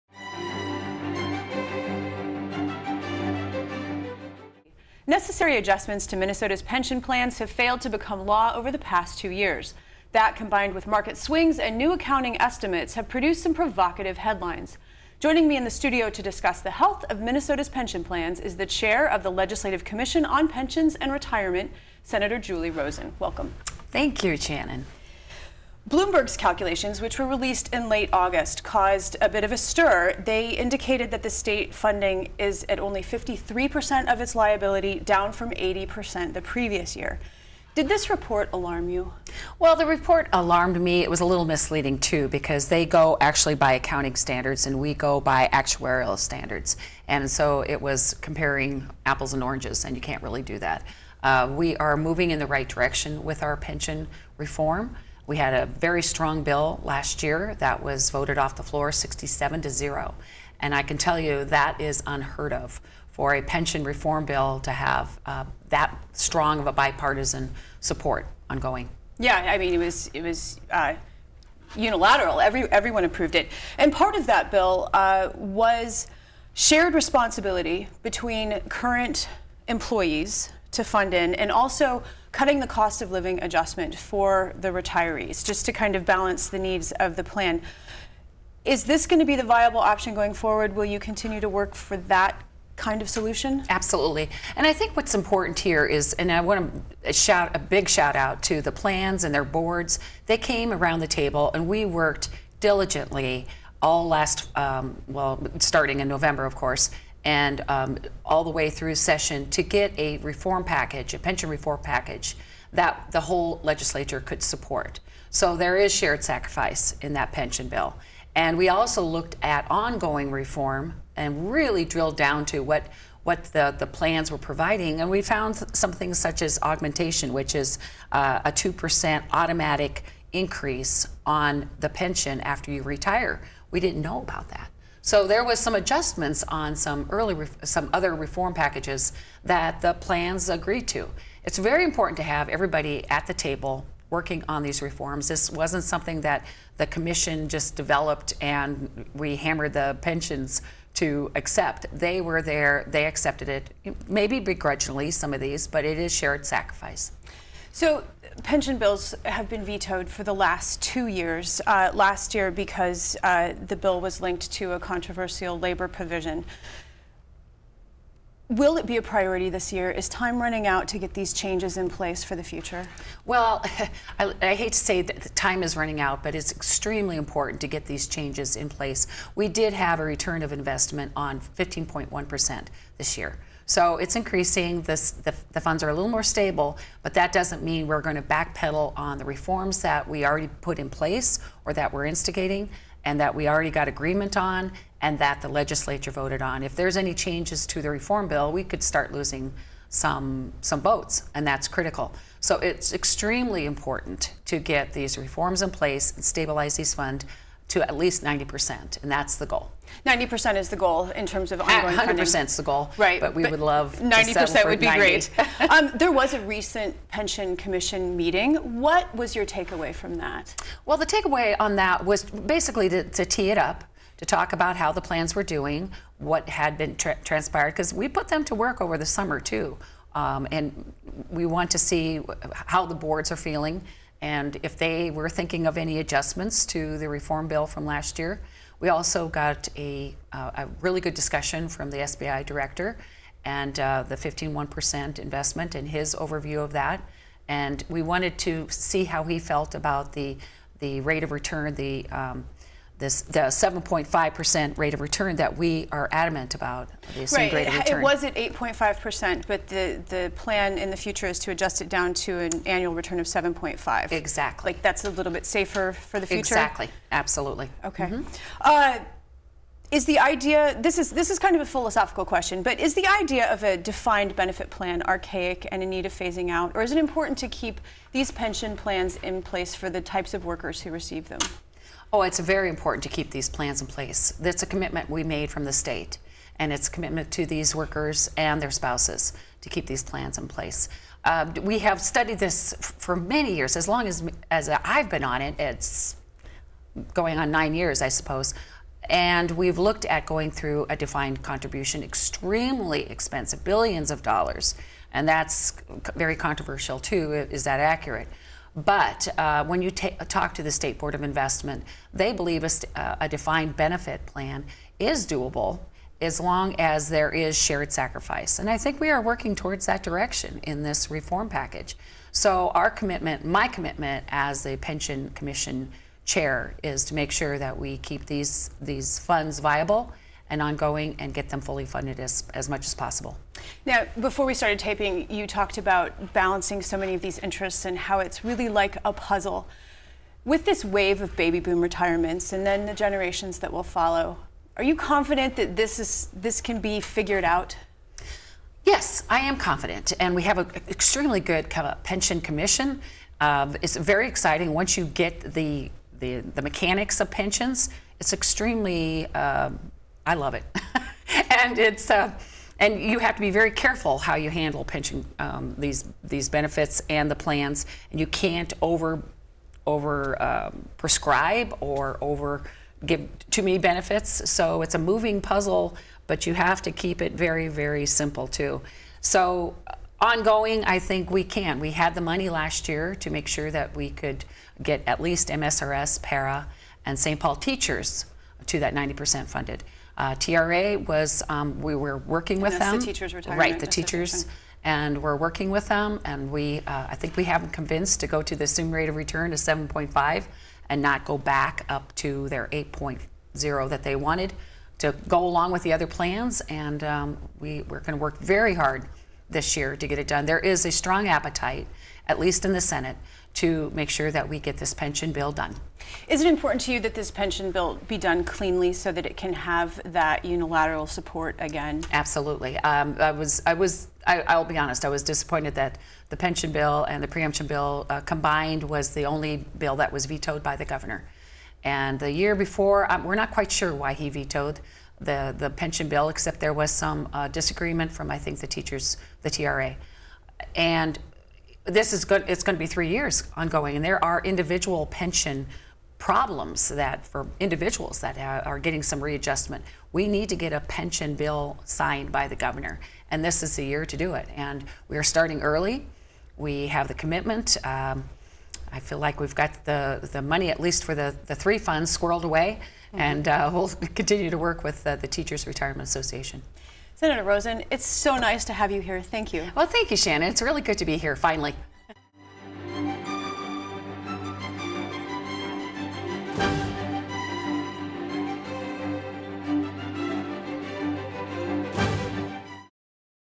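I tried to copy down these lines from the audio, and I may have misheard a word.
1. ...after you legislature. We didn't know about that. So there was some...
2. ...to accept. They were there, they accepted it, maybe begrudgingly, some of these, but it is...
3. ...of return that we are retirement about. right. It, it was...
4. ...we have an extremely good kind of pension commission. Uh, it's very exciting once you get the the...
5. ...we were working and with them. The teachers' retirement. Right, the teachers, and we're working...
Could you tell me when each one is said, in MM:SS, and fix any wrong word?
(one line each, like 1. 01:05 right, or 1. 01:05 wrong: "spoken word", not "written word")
1. 02:12 wrong: "retire", not "legislature"
2. 02:30 right
3. 04:14 wrong: "adamant", not "retirement"
4. 05:50 right
5. 06:31 right.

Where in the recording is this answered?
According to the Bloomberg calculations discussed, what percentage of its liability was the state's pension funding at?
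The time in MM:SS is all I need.
00:33.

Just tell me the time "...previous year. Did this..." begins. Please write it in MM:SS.
00:36.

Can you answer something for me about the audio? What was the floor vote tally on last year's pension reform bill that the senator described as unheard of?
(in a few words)
67 to 0.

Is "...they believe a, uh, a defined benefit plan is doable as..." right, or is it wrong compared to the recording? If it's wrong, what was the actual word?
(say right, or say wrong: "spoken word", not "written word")
right.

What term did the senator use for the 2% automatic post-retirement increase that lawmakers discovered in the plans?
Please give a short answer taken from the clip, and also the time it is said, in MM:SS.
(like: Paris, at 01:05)
augmentation, at 02:06.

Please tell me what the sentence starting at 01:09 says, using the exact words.
Yeah, I mean, it was, it was uh, unilateral.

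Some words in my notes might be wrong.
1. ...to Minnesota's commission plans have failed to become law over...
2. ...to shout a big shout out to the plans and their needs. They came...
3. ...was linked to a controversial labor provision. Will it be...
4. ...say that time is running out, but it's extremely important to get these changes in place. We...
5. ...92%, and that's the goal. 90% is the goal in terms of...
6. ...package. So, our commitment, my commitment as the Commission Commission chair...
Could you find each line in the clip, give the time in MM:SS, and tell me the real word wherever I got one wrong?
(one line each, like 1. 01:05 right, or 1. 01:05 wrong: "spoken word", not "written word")
1. 00:06 wrong: "pension", not "commission"
2. 01:37 wrong: "boards", not "needs"
3. 02:44 right
4. 02:54 right
5. 03:28 wrong: "90", not "92"
6. 05:21 wrong: "Pension", not "Commission".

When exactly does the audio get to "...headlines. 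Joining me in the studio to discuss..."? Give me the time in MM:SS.
00:14.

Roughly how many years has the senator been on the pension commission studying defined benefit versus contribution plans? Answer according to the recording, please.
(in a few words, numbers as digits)
9.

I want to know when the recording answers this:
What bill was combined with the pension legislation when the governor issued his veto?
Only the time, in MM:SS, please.
07:07.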